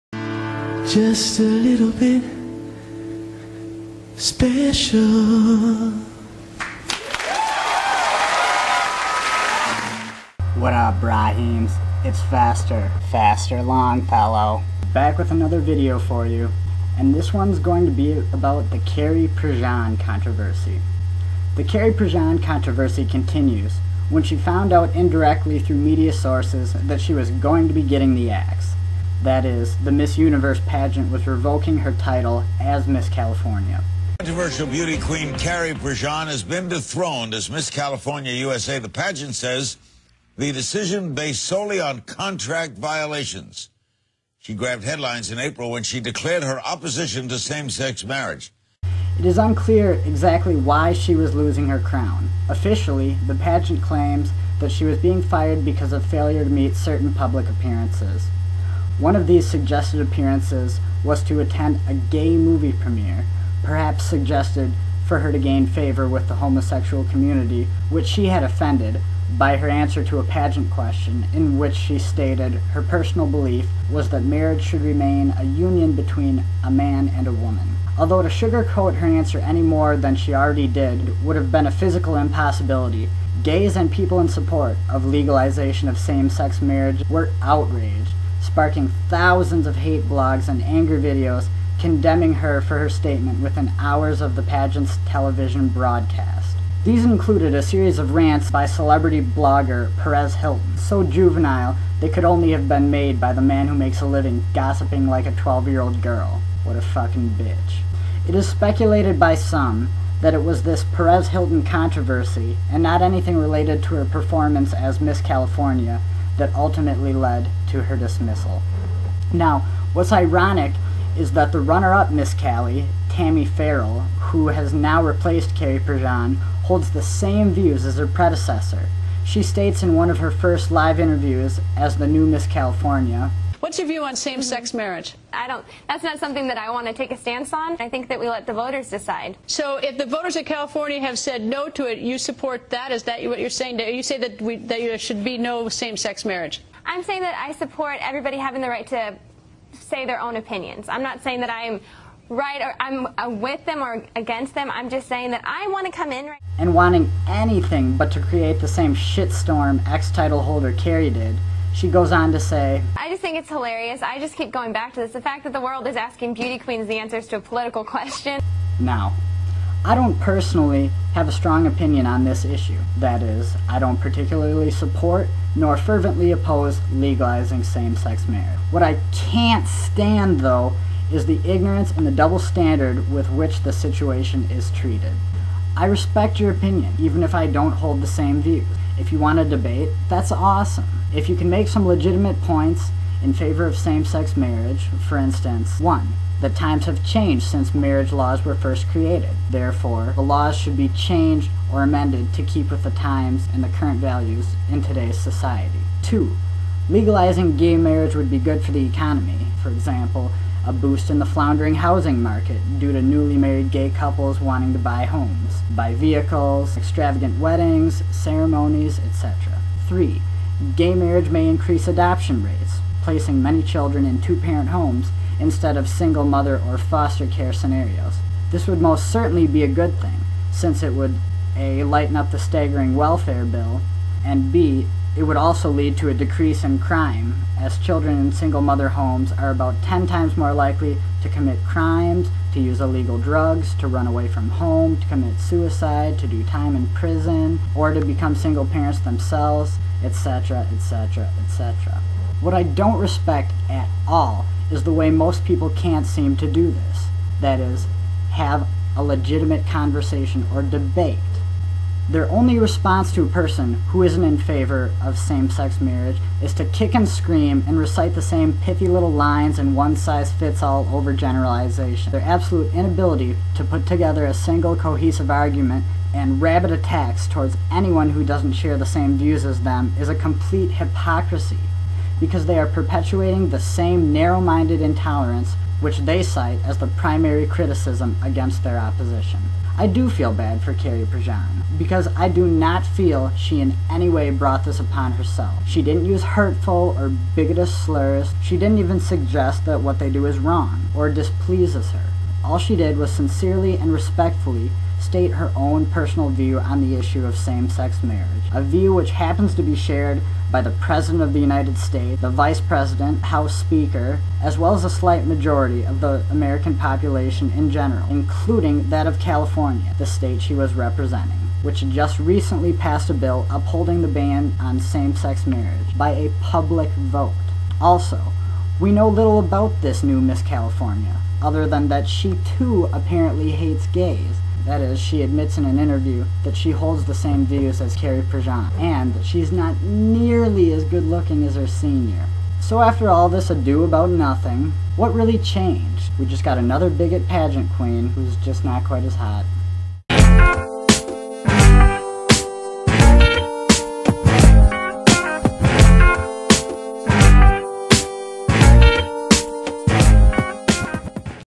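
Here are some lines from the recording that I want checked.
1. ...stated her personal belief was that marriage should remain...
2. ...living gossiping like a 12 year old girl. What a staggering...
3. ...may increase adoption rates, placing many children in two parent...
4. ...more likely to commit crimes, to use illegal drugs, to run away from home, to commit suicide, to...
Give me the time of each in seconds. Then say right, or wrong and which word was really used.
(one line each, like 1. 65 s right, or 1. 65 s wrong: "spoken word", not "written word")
1. 71 s right
2. 104 s wrong: "fucking", not "staggering"
3. 221 s right
4. 240 s right.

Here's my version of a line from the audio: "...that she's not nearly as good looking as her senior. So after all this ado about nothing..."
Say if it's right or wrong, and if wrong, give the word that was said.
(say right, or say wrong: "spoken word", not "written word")
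right.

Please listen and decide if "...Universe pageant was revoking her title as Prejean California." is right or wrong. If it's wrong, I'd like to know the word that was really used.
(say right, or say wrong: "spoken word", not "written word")
wrong: "Miss", not "Prejean".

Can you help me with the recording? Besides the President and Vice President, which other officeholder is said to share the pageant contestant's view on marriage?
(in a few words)
House Speaker.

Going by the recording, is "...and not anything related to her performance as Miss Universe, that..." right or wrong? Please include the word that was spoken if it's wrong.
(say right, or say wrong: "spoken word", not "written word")
wrong: "California", not "Universe".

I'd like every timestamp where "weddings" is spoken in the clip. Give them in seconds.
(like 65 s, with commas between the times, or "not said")
217 s.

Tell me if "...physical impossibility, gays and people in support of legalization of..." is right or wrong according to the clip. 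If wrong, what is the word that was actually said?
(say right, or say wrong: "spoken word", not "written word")
right.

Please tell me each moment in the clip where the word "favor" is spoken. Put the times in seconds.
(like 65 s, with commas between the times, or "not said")
65 s, 193 s, 264 s.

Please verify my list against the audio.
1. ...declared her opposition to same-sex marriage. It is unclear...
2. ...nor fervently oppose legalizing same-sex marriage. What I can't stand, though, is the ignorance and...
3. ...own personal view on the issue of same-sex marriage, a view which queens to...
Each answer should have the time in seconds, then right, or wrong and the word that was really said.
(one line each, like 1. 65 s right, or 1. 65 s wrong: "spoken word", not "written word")
1. 45 s right
2. 175 s right
3. 305 s wrong: "happens", not "queens".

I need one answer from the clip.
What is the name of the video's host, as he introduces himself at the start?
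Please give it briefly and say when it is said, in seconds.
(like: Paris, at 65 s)
Fester Longfellow, at 13 s.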